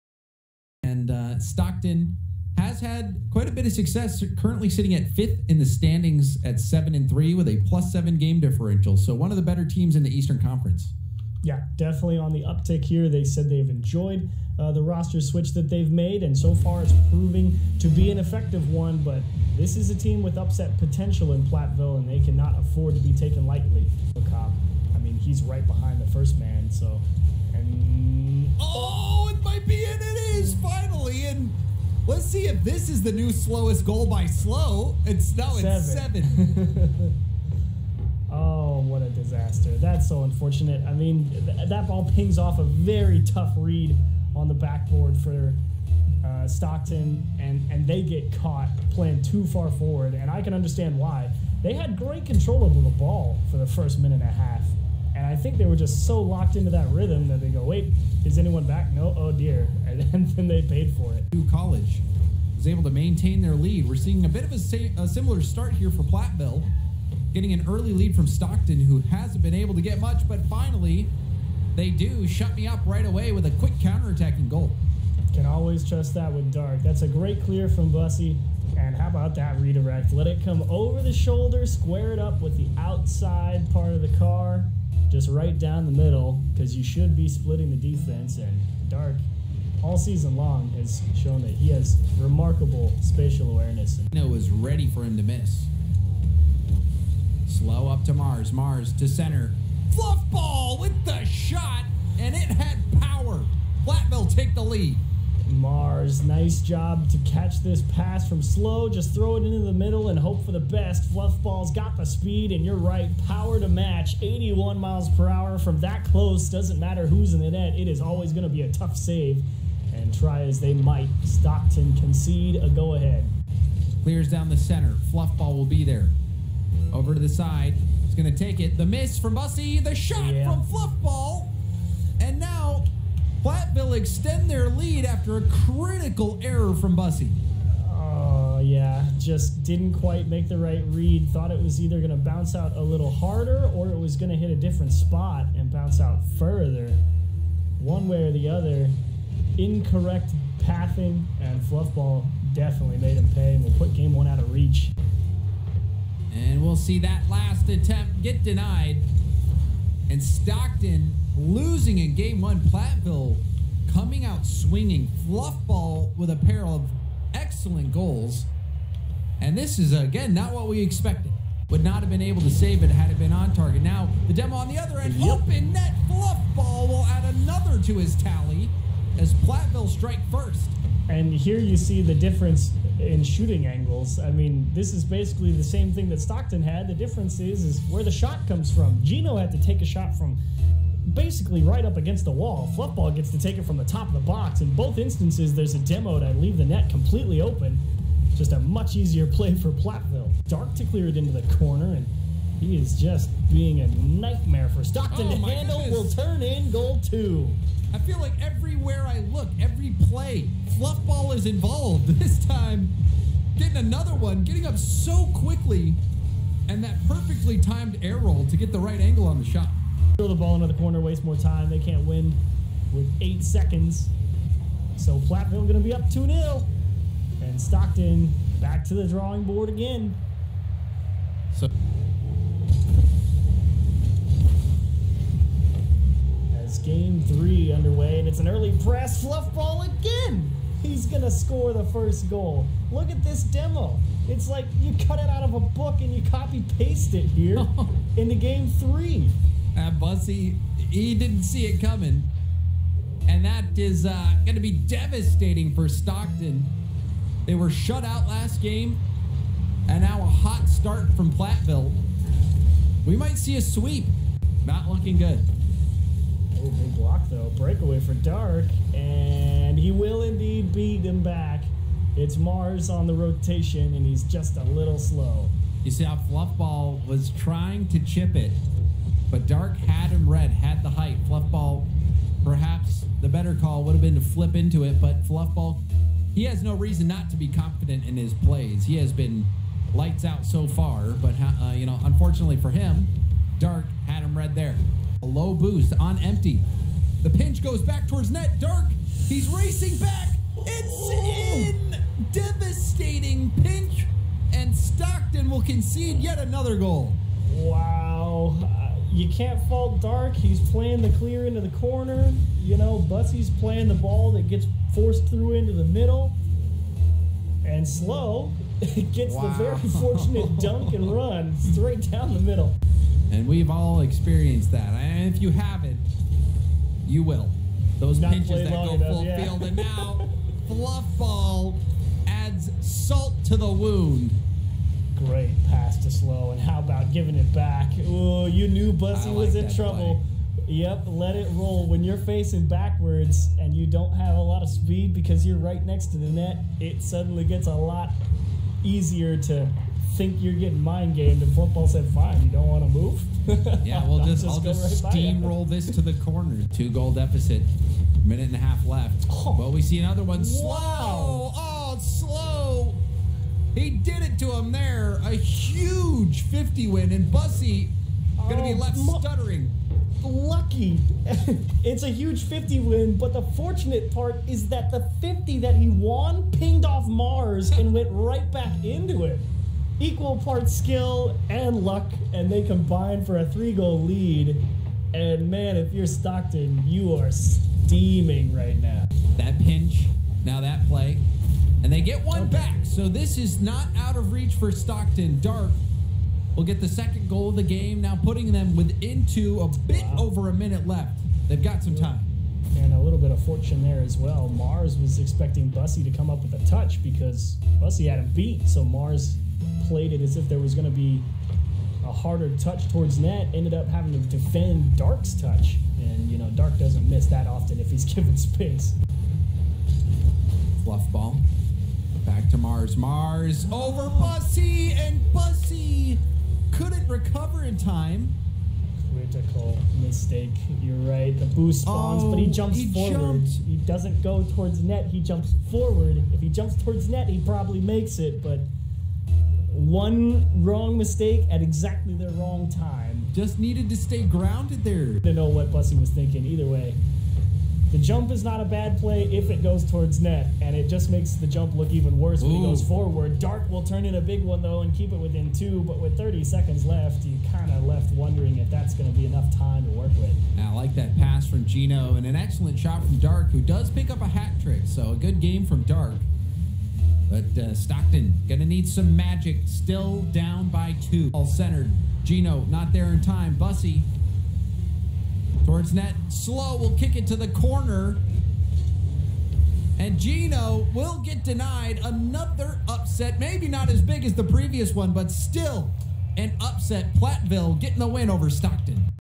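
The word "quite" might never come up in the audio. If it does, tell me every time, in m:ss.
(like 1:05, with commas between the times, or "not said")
0:03, 2:19.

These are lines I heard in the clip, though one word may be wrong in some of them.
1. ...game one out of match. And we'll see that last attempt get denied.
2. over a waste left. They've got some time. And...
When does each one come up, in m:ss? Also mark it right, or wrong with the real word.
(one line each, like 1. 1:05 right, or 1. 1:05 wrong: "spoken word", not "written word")
1. 2:33 wrong: "reach", not "match"
2. 6:40 wrong: "minute", not "waste".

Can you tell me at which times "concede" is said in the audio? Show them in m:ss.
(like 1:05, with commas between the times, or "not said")
2:01, 5:05.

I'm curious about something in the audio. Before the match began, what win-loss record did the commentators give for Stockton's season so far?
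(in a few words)
7 and 3.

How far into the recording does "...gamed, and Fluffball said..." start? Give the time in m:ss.
5:51.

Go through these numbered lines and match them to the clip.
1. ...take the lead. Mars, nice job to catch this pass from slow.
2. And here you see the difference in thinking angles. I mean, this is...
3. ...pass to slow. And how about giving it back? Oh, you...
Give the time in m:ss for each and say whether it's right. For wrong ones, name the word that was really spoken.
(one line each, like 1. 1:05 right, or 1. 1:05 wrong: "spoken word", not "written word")
1. 1:44 right
2. 3:01 wrong: "shooting", not "thinking"
3. 5:35 right.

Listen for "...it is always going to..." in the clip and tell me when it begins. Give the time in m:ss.
1:57.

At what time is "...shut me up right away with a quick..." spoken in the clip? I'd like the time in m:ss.
1:12.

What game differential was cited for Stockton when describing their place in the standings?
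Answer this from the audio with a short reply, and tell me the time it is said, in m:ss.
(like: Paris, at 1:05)
+7, at 0:07.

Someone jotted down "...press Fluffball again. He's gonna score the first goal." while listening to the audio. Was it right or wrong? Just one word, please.
right.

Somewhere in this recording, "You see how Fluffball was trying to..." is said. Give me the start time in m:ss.
4:35.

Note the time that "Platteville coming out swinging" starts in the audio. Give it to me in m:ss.
2:42.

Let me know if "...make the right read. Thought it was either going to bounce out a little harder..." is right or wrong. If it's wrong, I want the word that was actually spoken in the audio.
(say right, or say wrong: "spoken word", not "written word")
right.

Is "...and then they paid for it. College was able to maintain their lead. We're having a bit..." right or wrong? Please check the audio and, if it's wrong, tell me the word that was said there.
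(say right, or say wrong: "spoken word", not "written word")
wrong: "seeing", not "having".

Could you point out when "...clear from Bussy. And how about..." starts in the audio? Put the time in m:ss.
1:17.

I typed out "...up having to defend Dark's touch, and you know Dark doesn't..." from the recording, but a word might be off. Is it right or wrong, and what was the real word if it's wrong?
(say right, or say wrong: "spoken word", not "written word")
right.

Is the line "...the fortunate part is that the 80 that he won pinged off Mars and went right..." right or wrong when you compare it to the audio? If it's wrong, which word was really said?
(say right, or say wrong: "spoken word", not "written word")
wrong: "50", not "80".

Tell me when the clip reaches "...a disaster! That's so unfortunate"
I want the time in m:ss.
0:39.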